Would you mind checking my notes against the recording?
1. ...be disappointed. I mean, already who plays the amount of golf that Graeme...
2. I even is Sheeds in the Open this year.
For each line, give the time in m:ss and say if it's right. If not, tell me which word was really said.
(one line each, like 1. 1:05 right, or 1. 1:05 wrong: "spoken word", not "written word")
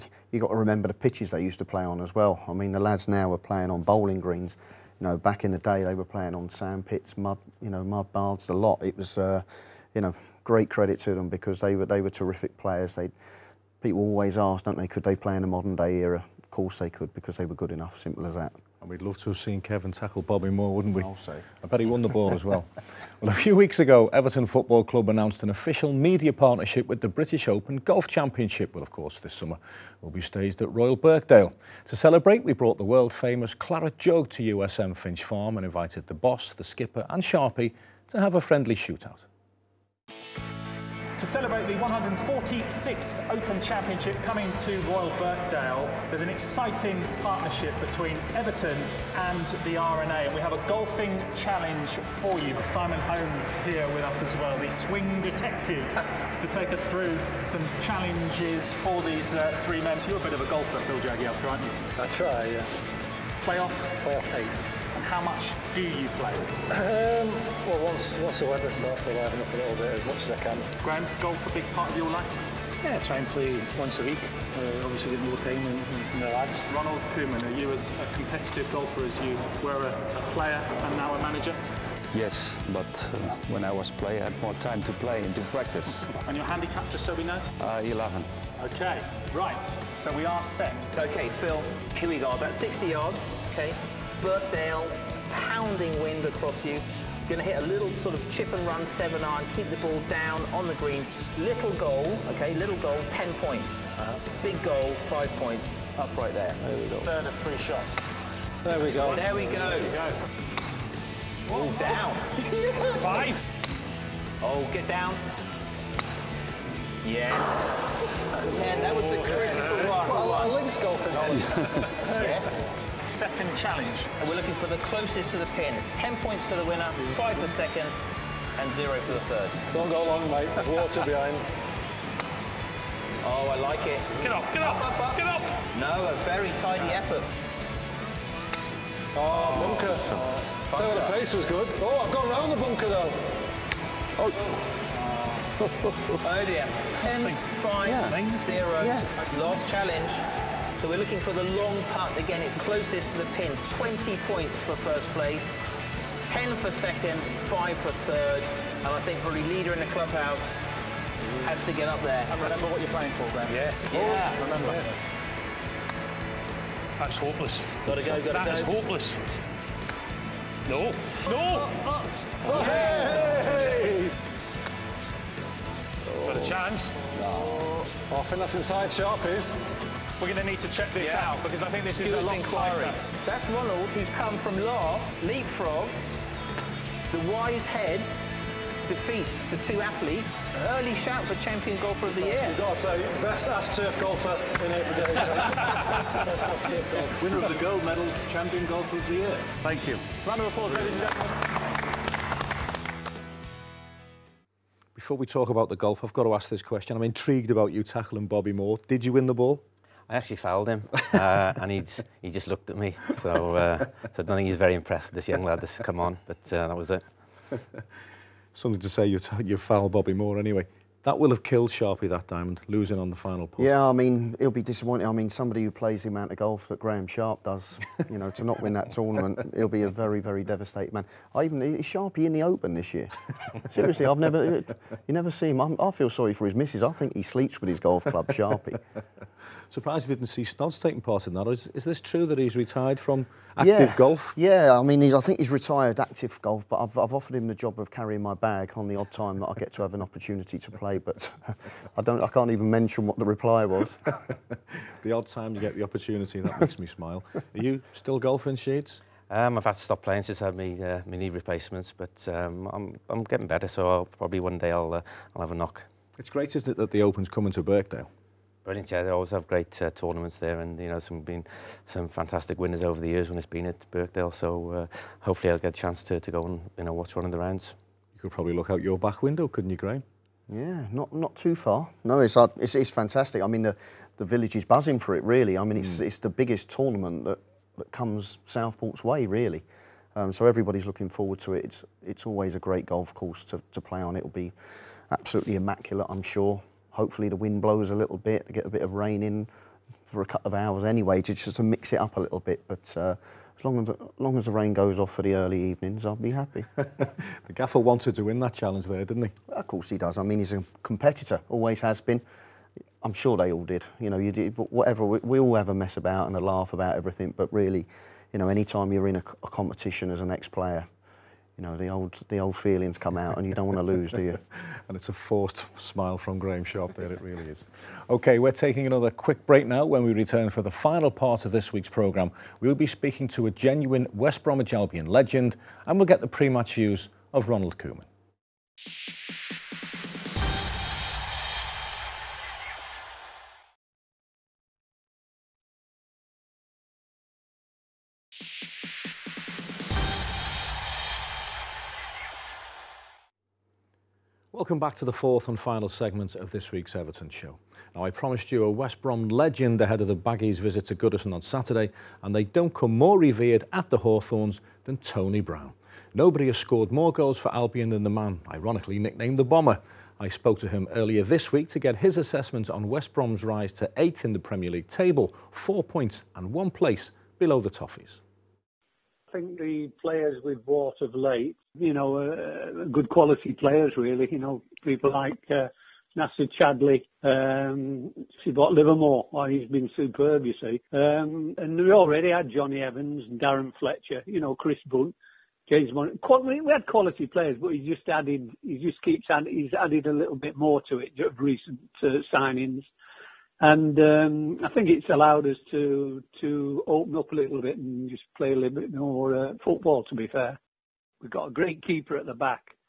1. 3:44 wrong: "somebody", not "already"
2. 3:51 wrong: "Sharpie", not "Sheeds".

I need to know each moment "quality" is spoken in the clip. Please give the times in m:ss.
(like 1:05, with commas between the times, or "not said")
6:23, 6:36.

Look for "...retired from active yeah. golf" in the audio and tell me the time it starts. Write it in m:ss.
4:02.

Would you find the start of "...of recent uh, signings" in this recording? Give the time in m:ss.
6:41.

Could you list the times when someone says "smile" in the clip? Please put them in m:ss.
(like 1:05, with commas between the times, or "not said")
4:16, 5:25.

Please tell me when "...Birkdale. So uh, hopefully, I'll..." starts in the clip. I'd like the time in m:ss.
4:33.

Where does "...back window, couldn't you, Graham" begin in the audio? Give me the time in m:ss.
4:38.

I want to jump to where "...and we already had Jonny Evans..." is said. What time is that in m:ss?
6:31.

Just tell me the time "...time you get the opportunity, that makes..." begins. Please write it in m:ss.
4:15.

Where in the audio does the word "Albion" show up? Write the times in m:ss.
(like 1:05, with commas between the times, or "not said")
5:34, 6:07.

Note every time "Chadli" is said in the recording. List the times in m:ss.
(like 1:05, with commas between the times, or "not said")
6:26.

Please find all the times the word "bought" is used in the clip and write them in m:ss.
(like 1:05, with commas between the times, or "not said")
6:20, 6:28.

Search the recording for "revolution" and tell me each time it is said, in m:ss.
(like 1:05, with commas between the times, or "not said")
not said.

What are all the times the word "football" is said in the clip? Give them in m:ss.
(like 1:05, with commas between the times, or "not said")
0:24, 6:49.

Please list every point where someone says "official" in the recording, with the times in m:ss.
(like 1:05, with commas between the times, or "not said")
0:25.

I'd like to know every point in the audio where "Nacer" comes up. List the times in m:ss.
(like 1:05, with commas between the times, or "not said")
6:26.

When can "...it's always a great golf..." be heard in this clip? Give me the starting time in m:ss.
4:52.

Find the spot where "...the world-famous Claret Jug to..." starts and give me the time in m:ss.
0:32.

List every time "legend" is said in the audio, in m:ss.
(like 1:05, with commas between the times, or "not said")
5:35, 5:59.